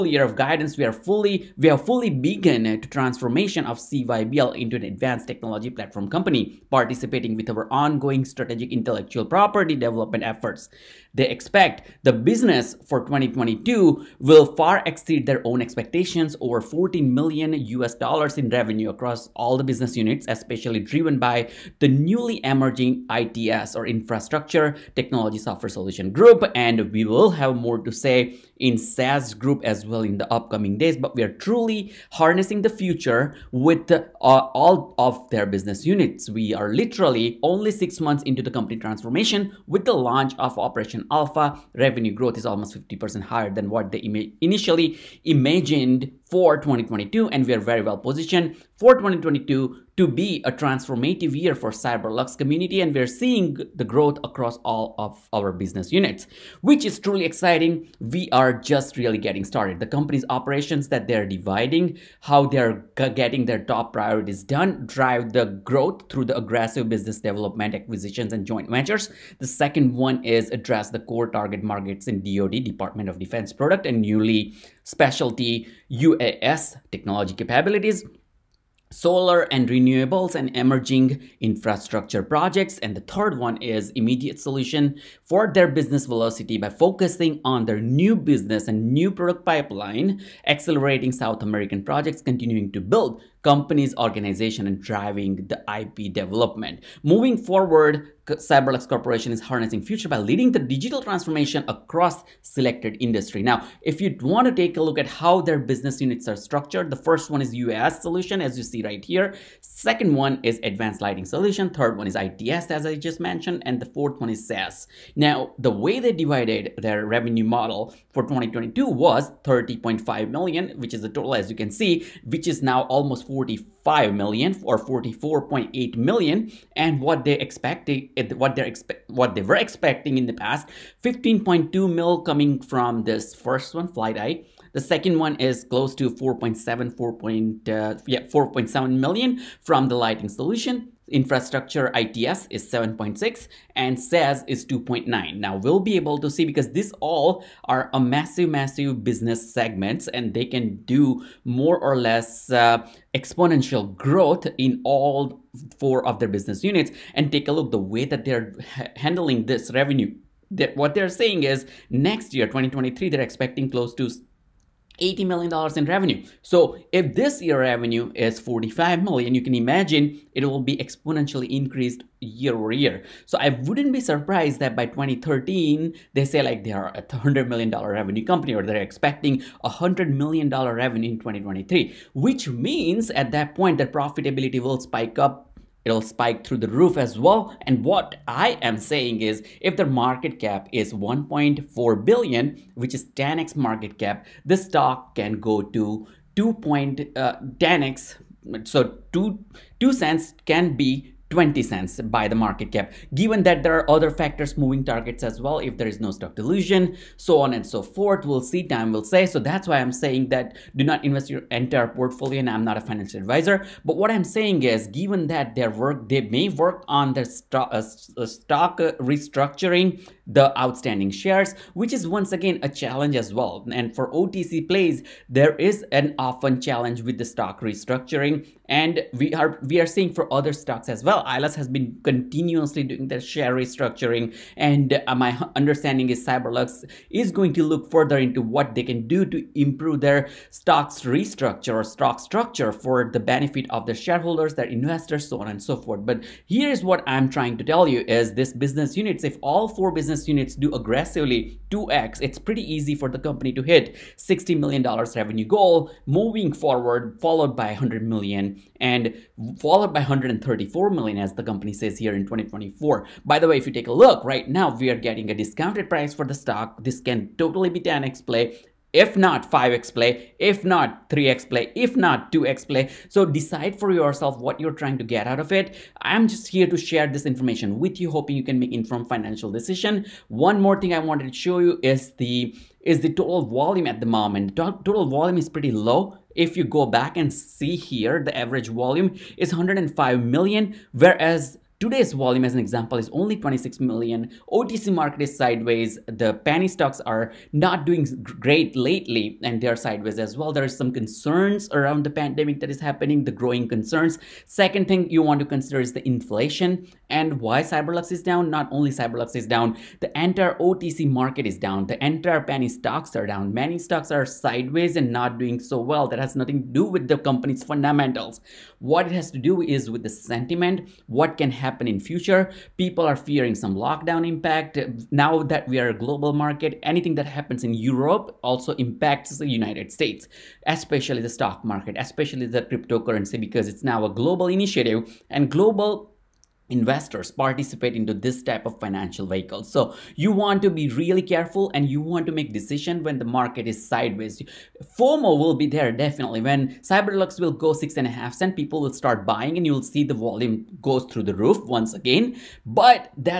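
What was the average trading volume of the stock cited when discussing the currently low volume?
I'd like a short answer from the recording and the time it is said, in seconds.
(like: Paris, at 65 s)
105 million, at 289 s.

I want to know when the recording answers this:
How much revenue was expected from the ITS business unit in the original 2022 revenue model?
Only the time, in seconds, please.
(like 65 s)
141 s.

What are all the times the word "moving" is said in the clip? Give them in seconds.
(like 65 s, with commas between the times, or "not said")
97 s, 204 s, 256 s.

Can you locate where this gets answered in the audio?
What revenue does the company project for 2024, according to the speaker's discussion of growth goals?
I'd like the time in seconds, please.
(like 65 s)
260 s.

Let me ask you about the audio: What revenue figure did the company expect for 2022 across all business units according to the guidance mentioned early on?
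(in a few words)
over 14 million US dollars.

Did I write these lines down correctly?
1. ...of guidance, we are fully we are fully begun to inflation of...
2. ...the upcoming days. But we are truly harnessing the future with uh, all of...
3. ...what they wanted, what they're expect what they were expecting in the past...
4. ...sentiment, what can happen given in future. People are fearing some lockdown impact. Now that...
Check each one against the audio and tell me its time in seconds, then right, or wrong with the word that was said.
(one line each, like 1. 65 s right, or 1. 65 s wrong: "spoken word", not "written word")
1. 0 s wrong: "transformation", not "inflation"
2. 30 s right
3. 126 s wrong: "expected", not "wanted"
4. 320 s wrong: "happen", not "given".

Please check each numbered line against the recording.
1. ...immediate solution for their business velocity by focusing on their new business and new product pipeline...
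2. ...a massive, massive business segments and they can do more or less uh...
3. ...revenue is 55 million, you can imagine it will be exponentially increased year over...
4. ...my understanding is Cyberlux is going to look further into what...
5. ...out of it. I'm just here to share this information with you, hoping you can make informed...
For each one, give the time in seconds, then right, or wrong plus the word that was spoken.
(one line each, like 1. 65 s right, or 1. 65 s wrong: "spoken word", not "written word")
1. 83 s right
2. 147 s right
3. 167 s wrong: "45", not "55"
4. 235 s right
5. 275 s right.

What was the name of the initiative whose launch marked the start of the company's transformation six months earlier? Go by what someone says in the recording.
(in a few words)
Operation alpha.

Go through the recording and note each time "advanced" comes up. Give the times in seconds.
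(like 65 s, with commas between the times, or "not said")
4 s, 110 s.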